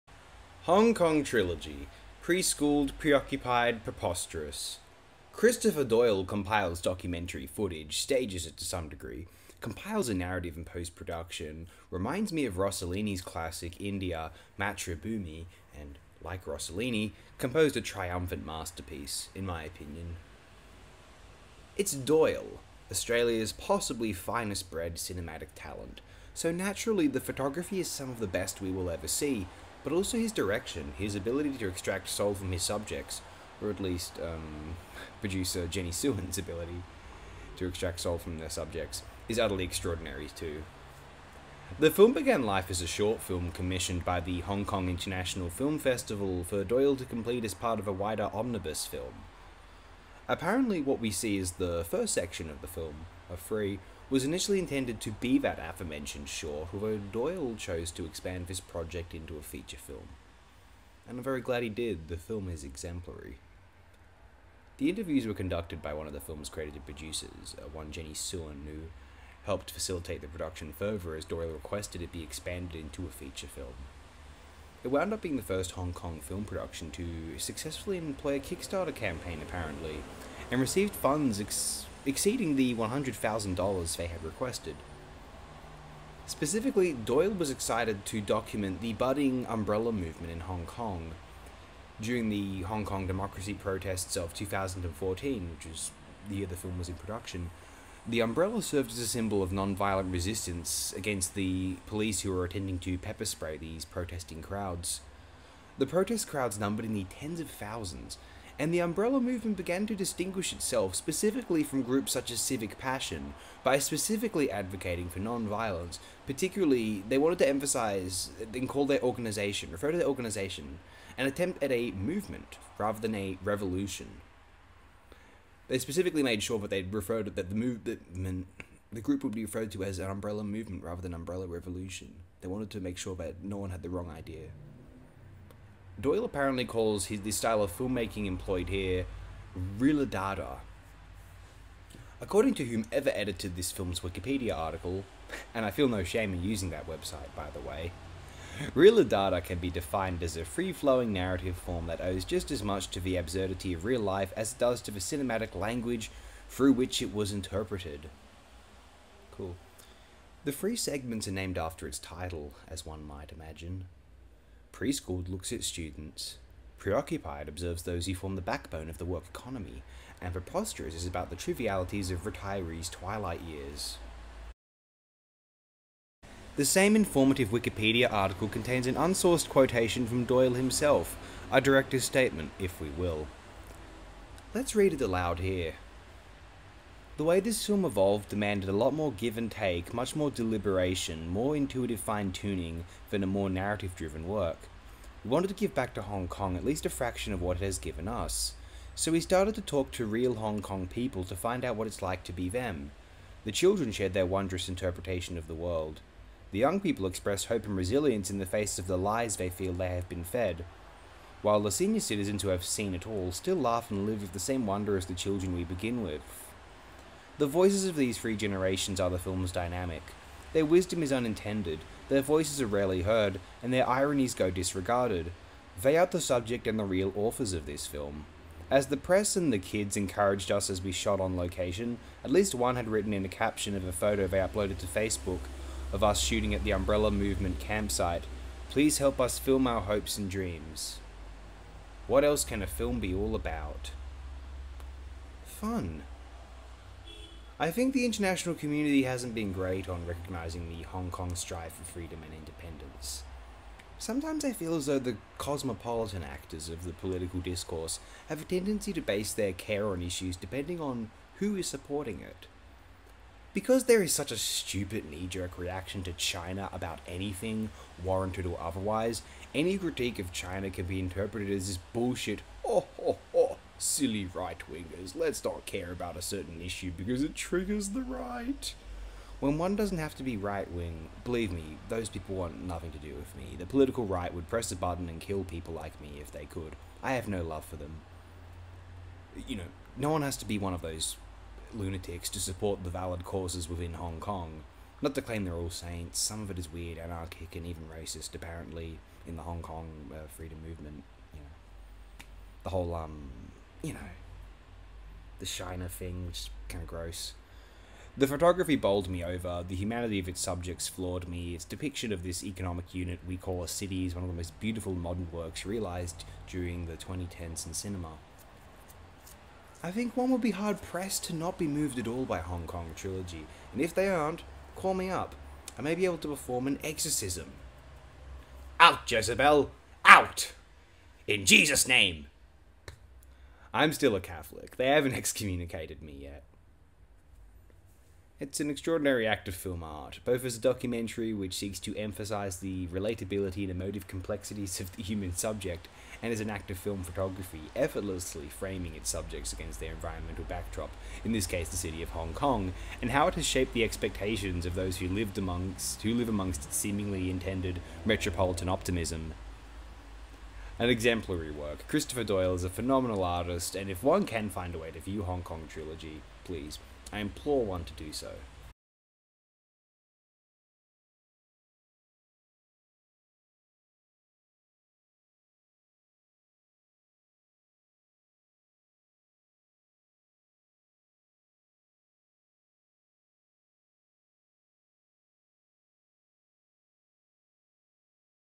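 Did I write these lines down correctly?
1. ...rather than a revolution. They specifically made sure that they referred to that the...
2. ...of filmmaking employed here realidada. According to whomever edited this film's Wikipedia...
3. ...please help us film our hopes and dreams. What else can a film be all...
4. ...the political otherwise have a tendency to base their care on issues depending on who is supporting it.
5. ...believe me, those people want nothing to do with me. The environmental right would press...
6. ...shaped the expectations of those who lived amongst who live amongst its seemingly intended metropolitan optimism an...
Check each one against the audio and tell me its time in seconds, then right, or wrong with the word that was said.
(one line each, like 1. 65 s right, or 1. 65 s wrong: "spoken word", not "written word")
1. 122 s right
2. 137 s right
3. 238 s right
4. 256 s wrong: "discourse", not "otherwise"
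5. 281 s wrong: "political", not "environmental"
6. 353 s right.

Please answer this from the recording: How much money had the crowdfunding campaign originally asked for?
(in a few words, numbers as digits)
$100,000.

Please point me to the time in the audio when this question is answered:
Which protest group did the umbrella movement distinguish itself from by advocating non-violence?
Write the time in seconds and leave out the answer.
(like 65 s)
112 s.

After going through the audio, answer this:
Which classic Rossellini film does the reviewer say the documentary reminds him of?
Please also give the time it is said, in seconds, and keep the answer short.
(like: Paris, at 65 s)
India, Matribhumi, at 13 s.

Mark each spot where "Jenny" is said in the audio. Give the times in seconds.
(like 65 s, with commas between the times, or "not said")
35 s, 67 s.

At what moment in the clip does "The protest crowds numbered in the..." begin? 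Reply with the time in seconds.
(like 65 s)
105 s.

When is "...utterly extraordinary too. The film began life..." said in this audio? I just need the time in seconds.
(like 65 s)
39 s.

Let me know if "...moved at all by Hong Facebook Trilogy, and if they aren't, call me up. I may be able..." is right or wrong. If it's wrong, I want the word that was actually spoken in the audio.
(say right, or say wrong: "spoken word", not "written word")
wrong: "Kong", not "Facebook".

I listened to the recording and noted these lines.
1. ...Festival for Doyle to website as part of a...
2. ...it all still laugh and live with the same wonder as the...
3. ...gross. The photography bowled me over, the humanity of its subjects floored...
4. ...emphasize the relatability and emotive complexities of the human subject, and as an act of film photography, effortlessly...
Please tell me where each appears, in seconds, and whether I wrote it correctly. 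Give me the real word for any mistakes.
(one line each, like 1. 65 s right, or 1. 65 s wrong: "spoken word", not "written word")
1. 45 s wrong: "complete", not "website"
2. 212 s right
3. 306 s right
4. 341 s right.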